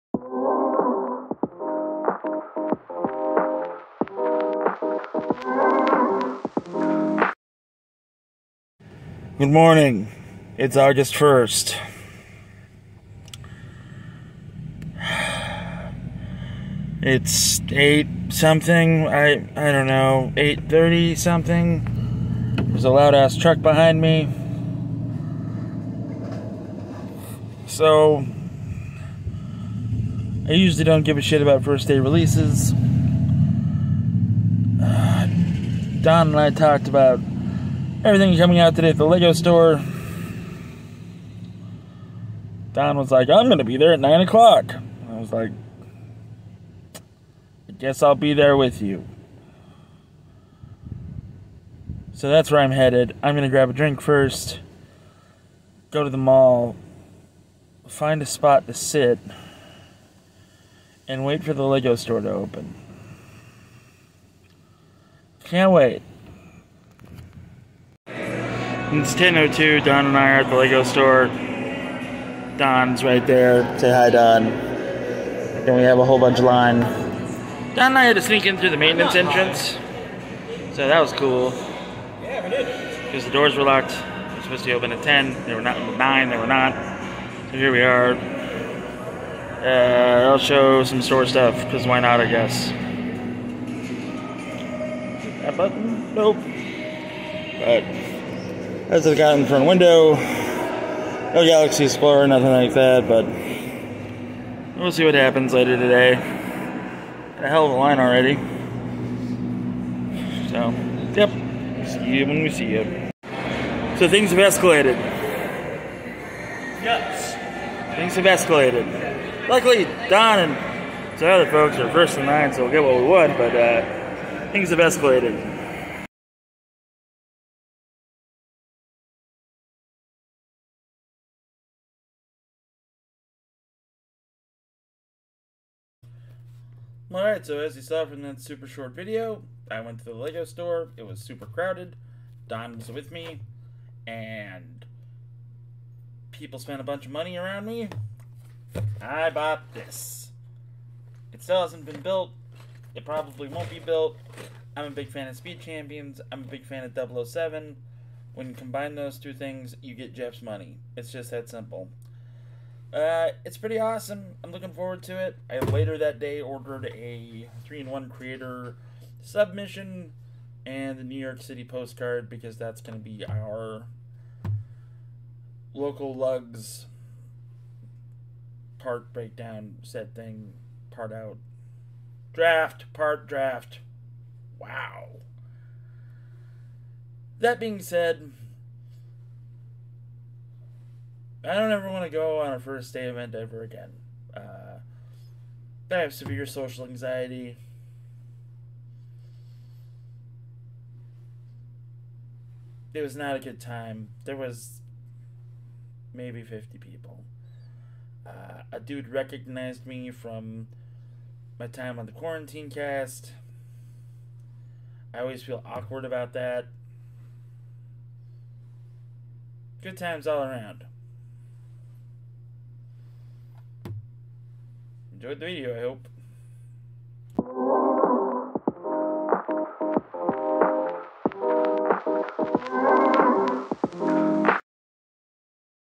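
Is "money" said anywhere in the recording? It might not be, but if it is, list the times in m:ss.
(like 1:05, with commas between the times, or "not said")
2:27, 2:40.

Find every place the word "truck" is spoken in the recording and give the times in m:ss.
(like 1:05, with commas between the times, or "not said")
0:23.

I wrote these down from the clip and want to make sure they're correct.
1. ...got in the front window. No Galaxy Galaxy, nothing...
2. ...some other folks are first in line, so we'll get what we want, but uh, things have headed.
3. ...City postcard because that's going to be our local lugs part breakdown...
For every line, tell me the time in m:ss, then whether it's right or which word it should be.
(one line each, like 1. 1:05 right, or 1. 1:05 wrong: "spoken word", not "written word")
1. 1:39 wrong: "Explorer", not "Galaxy"
2. 2:01 wrong: "escalated", not "headed"
3. 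2:51 right.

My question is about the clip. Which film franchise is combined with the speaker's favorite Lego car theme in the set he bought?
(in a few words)
007.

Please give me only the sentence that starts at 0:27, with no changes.
So, I usually don't give a shit about first day releases.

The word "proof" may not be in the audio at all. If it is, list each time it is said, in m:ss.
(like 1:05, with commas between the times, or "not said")
not said.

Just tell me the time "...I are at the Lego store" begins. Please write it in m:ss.
1:10.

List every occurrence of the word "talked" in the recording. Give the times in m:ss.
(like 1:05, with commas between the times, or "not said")
0:36.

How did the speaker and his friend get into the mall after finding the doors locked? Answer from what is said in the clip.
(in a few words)
maintenance entrance.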